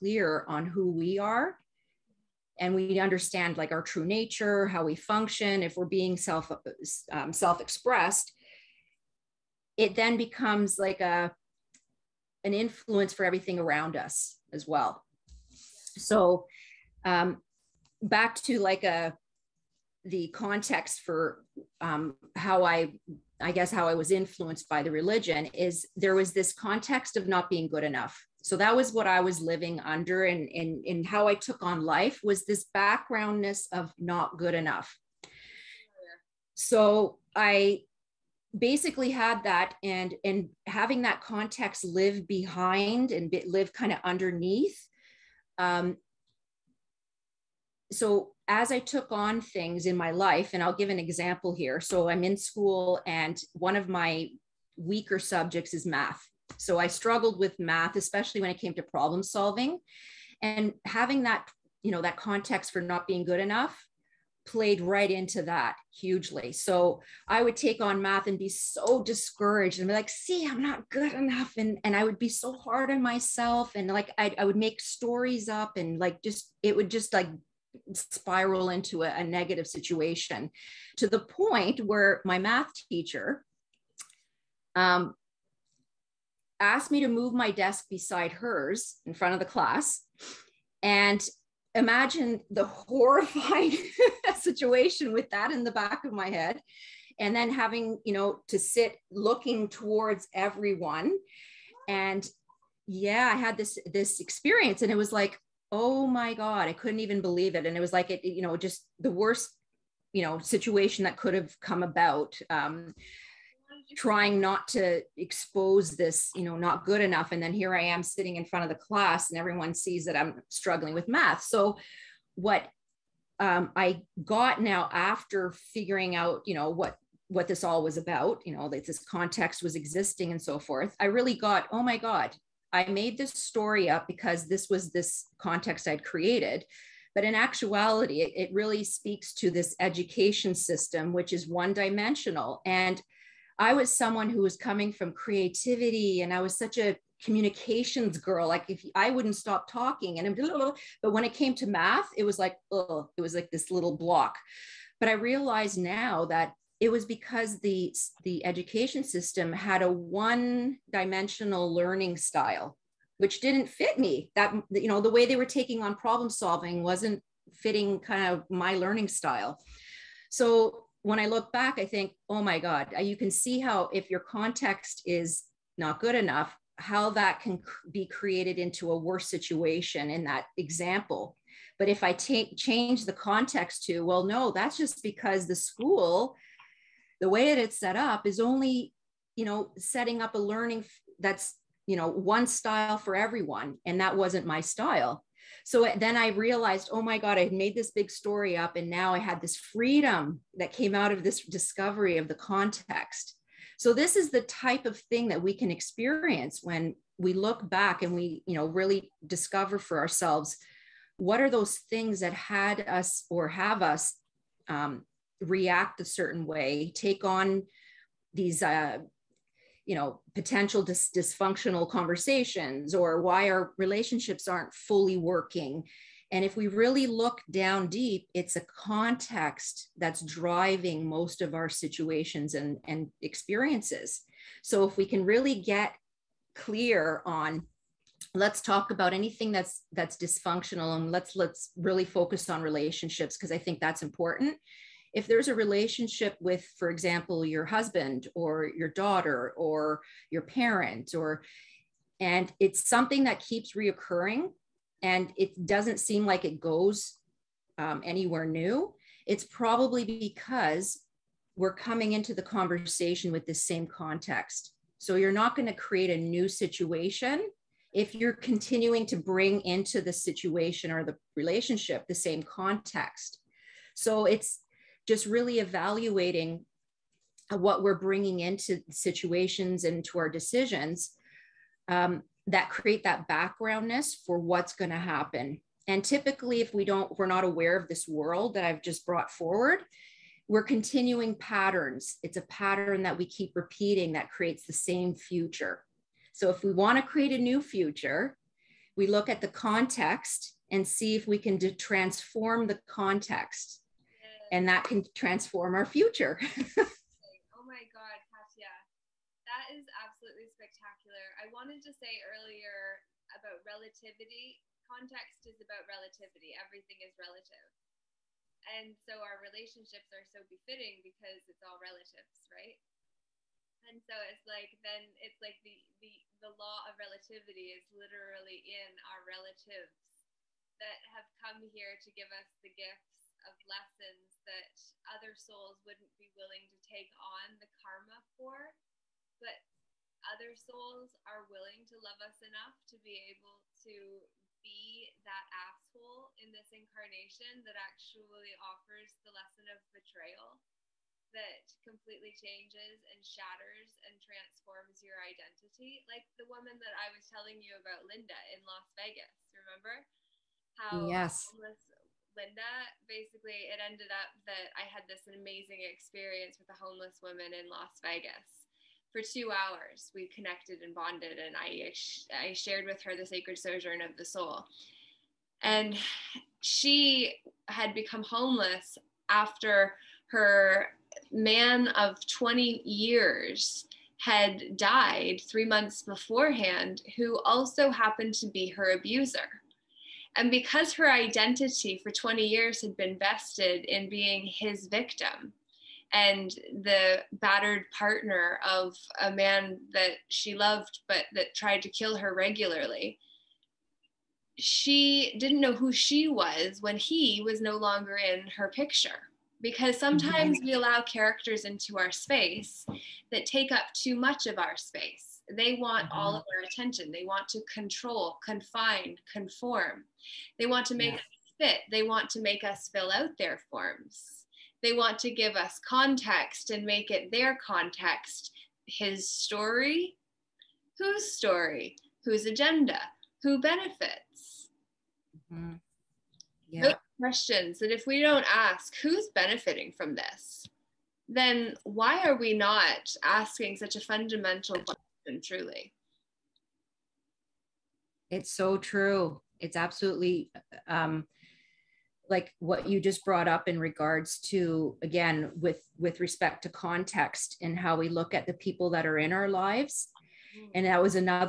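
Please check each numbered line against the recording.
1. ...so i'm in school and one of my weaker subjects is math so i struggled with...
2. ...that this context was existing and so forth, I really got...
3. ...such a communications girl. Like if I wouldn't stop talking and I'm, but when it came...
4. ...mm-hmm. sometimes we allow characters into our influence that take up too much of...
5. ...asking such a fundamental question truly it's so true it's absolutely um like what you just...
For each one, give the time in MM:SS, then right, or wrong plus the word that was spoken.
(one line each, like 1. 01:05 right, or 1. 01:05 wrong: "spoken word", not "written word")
1. 00:51 right
2. 02:08 right
3. 02:26 right
4. 06:49 wrong: "space", not "influence"
5. 07:23 right.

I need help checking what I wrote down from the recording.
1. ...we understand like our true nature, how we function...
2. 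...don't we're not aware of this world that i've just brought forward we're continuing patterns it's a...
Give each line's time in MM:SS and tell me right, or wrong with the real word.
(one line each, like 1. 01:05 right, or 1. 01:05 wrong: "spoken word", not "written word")
1. 00:02 right
2. 04:46 right.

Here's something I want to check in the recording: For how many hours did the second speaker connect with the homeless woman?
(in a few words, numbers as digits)
2.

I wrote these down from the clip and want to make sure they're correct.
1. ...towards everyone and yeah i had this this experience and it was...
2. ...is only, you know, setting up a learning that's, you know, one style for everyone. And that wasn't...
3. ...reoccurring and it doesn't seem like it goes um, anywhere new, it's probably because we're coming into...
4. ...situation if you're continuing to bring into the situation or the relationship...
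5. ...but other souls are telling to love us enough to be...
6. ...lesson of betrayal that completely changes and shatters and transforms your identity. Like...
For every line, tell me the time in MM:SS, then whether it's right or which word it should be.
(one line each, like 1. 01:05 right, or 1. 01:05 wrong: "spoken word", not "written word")
1. 01:39 right
2. 03:08 right
3. 04:13 right
4. 04:26 right
5. 05:39 wrong: "willing", not "telling"
6. 05:49 right.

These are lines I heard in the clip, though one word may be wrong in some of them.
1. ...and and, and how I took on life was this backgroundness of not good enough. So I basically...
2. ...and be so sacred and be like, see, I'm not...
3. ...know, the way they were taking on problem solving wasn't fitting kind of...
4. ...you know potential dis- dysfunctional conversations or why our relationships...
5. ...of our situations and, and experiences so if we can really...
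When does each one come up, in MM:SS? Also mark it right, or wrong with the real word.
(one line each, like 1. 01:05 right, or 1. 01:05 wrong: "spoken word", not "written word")
1. 00:30 right
2. 01:08 wrong: "discouraged", not "sacred"
3. 02:44 right
4. 03:39 right
5. 03:51 right.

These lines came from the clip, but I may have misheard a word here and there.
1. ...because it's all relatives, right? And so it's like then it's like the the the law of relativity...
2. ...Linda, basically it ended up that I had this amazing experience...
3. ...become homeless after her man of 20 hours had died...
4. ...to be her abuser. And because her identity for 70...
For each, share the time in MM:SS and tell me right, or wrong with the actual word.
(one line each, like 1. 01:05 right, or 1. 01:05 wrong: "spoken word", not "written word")
1. 05:21 right
2. 06:02 right
3. 06:17 wrong: "years", not "hours"
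4. 06:28 wrong: "20", not "70".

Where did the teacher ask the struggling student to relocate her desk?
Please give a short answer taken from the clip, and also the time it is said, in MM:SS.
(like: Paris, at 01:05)
Beside hers, at 01:27.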